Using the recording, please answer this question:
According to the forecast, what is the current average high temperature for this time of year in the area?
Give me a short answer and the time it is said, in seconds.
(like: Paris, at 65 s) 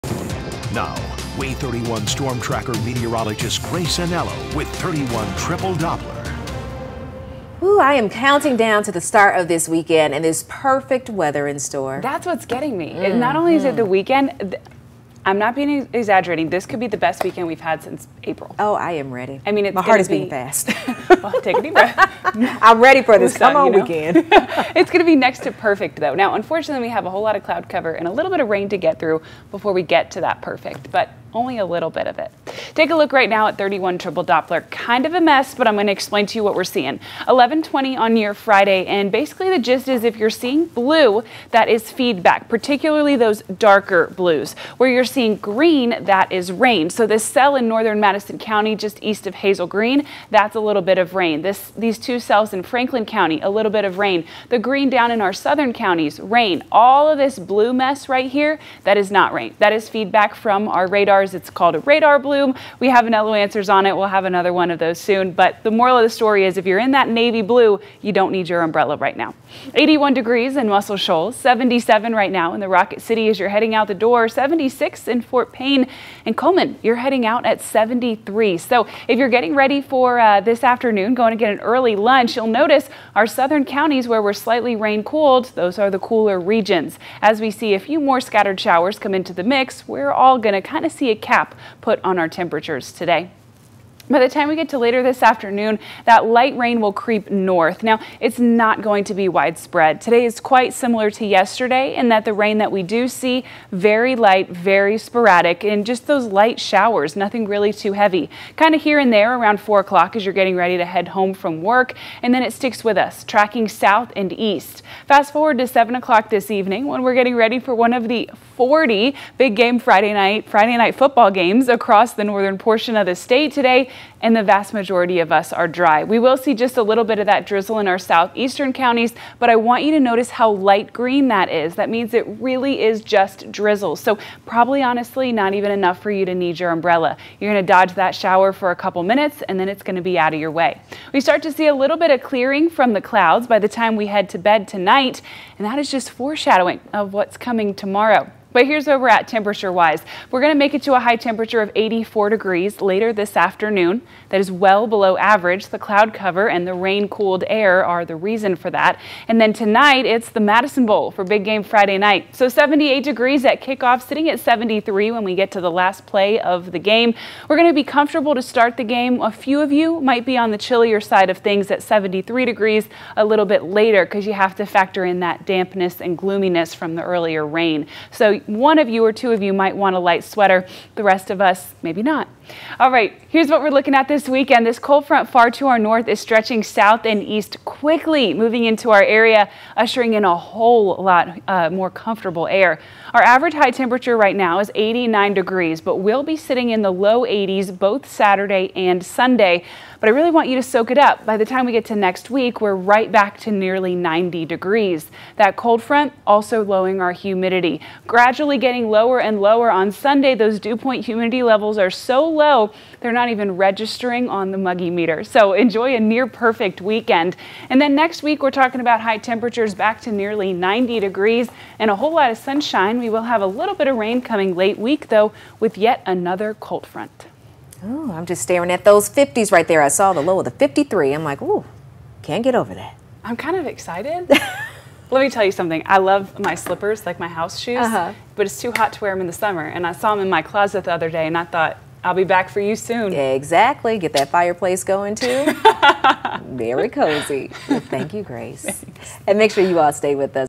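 89 degrees, at 194 s.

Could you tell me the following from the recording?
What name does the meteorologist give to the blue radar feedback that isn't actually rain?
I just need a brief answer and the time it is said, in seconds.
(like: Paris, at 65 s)
radar bloom, at 61 s.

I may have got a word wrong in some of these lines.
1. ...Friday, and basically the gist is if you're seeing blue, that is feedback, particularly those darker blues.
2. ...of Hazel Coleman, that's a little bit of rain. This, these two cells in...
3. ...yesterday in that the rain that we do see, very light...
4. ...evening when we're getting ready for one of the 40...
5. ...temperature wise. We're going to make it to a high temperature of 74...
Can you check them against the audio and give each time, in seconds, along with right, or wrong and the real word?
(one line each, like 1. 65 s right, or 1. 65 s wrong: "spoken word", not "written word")
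1. 38 s right
2. 49 s wrong: "Green", not "Coleman"
3. 101 s right
4. 116 s right
5. 149 s wrong: "84", not "74".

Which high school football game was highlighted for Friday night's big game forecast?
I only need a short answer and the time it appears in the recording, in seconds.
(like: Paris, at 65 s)
Madison Bowl, at 160 s.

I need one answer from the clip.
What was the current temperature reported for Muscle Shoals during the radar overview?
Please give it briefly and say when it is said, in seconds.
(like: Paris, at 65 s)
81 degrees, at 69 s.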